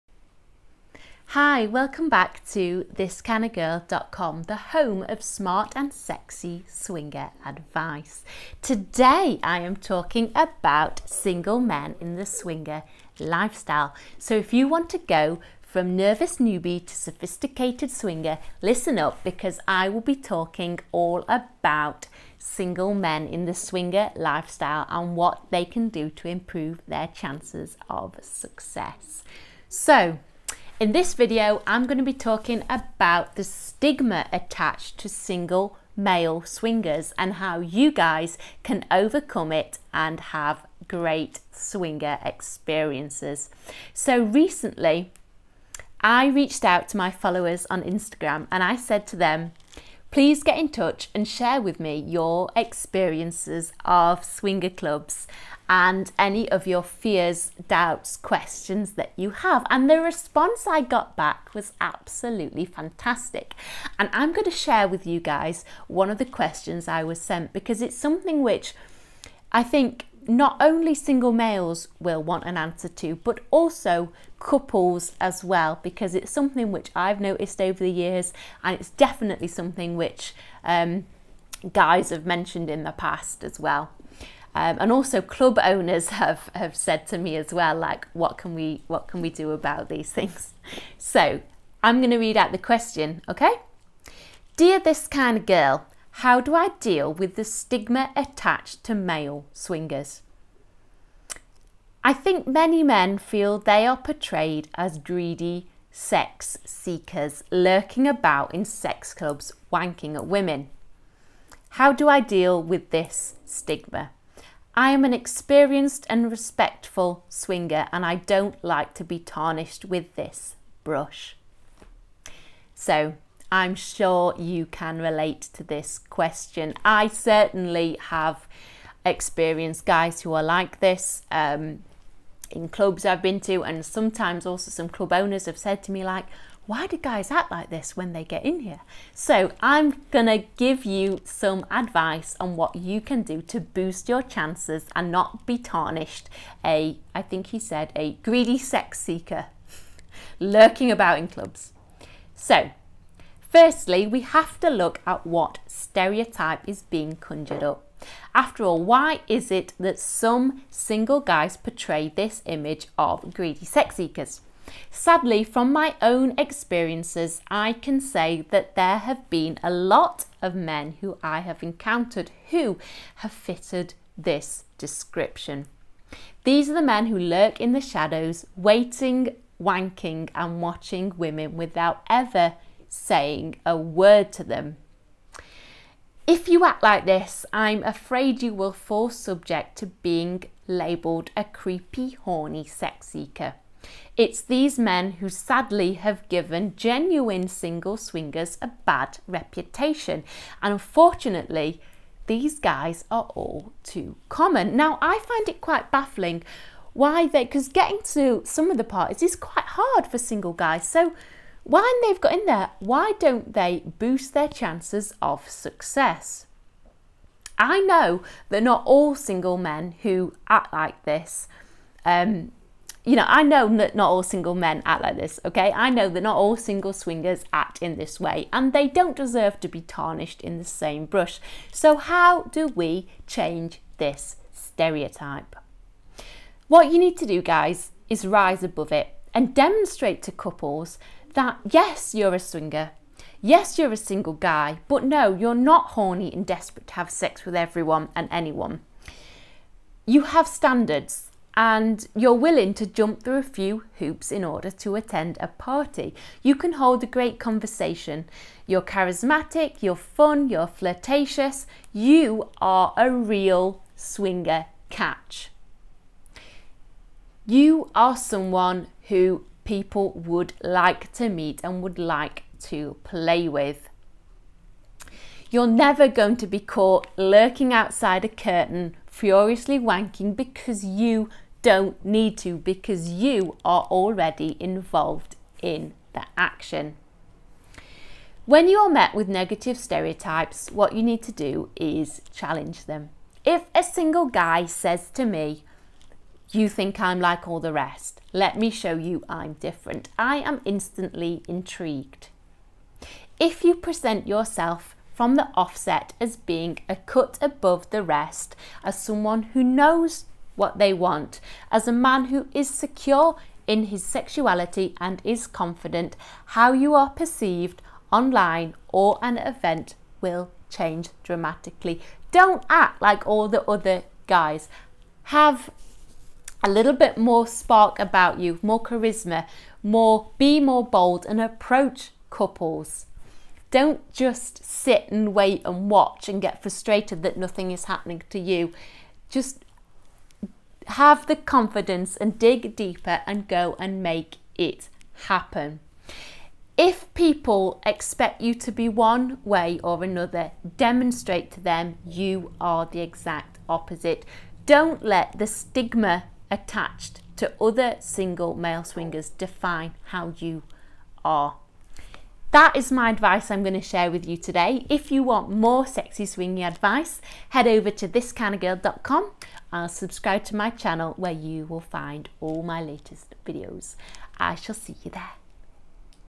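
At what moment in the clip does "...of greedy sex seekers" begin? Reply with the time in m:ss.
2:42.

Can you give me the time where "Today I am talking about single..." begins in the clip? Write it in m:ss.
0:08.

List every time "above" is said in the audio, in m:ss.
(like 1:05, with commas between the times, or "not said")
3:58, 5:07.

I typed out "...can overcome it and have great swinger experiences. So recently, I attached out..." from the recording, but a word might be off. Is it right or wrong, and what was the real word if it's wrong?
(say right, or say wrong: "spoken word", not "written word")
wrong: "reached", not "attached".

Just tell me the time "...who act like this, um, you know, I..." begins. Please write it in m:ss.
3:40.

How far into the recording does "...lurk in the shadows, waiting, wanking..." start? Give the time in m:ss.
2:57.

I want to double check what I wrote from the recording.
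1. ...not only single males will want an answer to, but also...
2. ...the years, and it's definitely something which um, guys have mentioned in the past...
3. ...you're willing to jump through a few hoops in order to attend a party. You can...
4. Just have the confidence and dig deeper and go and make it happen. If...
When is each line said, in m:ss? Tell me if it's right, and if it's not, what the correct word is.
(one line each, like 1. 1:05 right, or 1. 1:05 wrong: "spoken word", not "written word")
1. 1:10 right
2. 1:17 right
3. 4:12 right
4. 5:39 right.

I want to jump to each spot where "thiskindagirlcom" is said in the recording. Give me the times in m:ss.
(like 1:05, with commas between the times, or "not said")
0:02, 6:08.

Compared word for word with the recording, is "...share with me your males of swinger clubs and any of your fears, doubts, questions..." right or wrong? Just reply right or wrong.
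wrong.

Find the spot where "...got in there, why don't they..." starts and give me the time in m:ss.
3:32.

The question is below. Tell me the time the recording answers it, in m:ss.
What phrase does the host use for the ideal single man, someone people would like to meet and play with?
4:23.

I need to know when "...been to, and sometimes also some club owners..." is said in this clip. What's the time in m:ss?
2:13.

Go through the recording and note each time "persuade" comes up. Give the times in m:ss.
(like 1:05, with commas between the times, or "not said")
not said.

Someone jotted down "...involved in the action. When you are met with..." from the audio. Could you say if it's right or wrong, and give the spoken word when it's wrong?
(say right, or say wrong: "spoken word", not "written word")
right.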